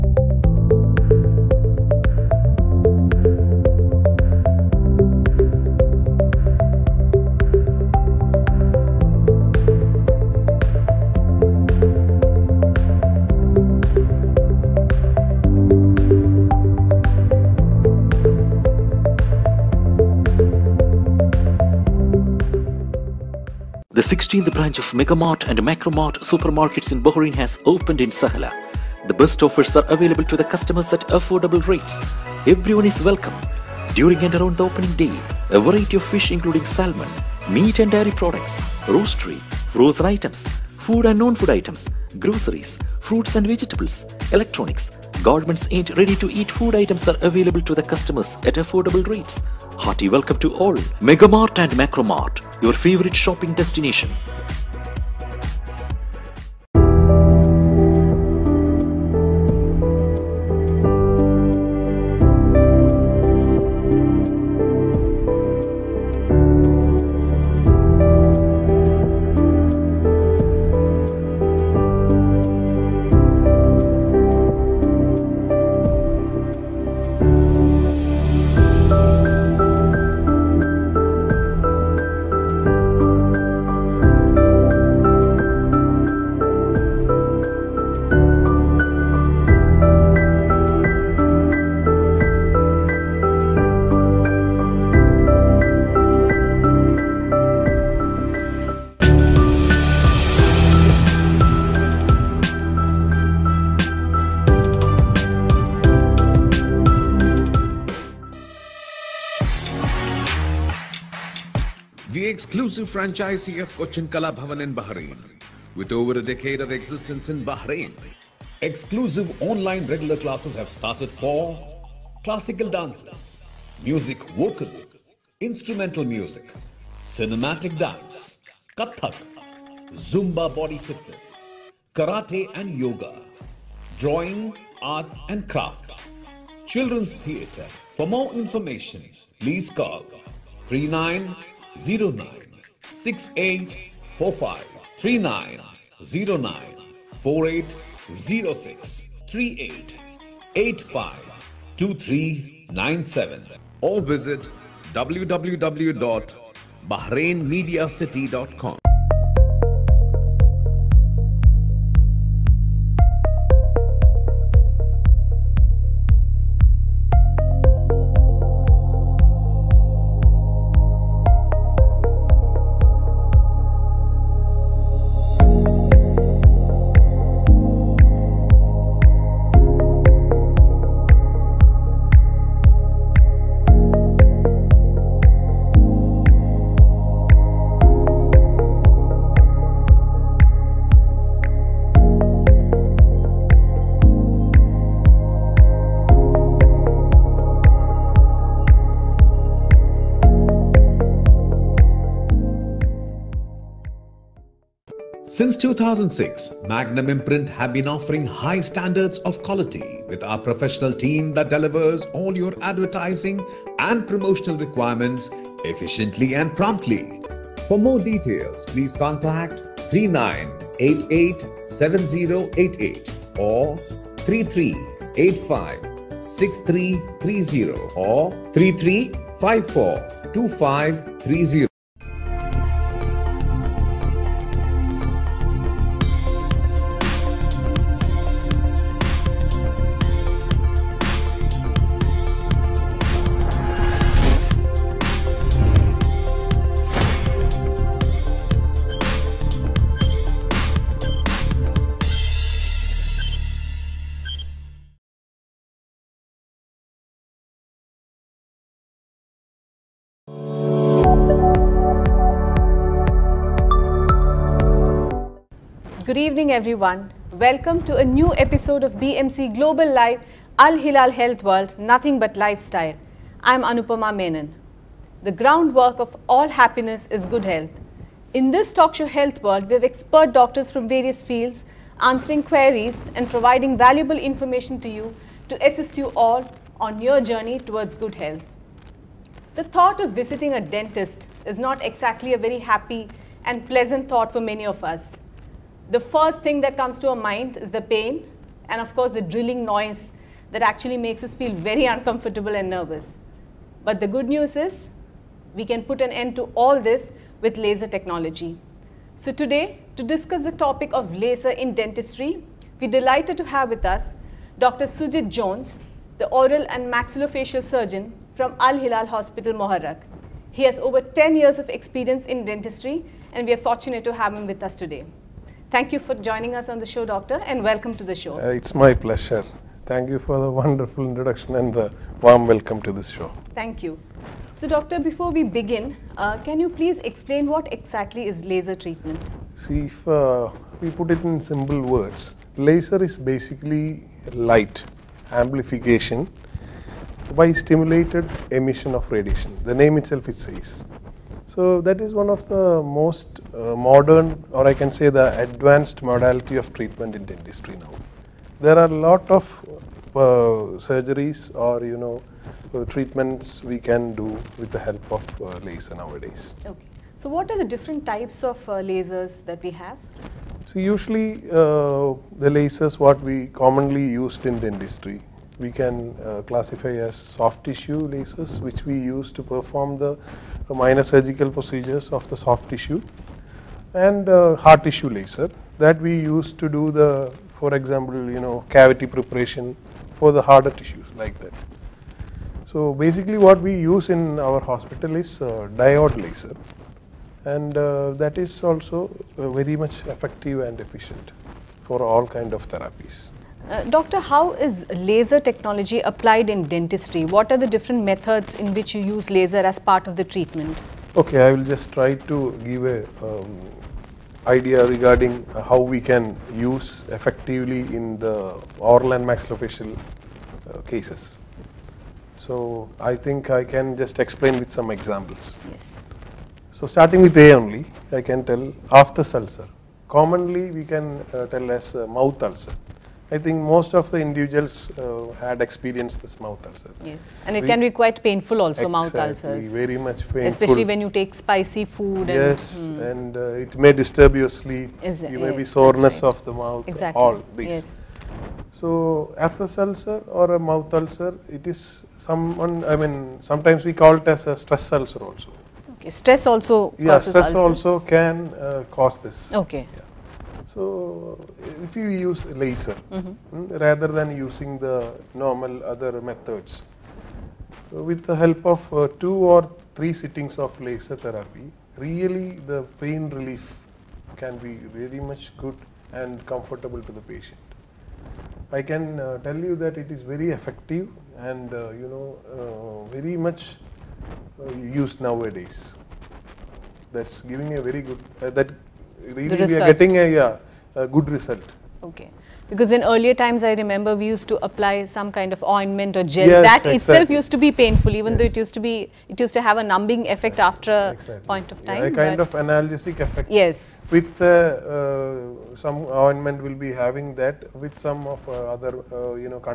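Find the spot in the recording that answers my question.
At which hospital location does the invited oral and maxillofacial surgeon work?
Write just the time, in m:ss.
5:19.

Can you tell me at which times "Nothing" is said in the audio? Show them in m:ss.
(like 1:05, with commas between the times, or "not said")
4:31.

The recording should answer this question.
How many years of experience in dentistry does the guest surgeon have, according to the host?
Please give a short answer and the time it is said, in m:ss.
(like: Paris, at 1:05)
10, at 5:21.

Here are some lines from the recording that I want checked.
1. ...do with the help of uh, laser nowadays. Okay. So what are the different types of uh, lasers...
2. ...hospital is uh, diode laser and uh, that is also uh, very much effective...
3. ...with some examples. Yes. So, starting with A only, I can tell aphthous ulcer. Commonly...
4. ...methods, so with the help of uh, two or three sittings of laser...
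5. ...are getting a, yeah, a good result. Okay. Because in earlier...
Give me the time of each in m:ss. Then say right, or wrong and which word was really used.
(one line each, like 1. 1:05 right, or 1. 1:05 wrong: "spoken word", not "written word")
1. 6:04 right
2. 6:34 right
3. 7:04 right
4. 7:46 right
5. 8:09 right.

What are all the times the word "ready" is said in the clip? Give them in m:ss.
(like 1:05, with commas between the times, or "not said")
0:45.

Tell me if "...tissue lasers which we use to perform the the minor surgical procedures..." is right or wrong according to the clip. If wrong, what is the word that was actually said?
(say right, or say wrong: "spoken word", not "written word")
right.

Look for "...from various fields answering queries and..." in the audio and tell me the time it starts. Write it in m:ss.
4:40.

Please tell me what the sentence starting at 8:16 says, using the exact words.
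itself used to be painful, even yes.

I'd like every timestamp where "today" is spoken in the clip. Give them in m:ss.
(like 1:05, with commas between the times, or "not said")
5:09, 5:24.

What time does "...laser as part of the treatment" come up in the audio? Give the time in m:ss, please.
6:49.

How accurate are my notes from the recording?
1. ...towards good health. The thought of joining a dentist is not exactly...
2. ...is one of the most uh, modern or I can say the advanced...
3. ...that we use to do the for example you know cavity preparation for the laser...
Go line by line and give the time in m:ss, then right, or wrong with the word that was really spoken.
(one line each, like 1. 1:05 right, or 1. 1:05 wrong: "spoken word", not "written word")
1. 4:47 wrong: "visiting", not "joining"
2. 5:52 right
3. 6:25 wrong: "harder", not "laser".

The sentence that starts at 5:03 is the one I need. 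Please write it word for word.
But the good news is we can put an end to all this with laser technology.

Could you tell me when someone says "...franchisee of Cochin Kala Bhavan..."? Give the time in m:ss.
1:52.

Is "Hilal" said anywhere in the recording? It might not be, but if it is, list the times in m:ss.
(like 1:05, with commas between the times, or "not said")
4:30, 5:18.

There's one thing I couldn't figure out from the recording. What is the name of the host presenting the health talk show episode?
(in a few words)
Anupama Menon.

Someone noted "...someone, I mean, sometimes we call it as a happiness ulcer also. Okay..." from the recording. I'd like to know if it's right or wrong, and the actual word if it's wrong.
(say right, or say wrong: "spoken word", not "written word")
wrong: "stress", not "happiness".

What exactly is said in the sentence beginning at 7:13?
I think most of the individuals uh, had experienced this mouth ulcer.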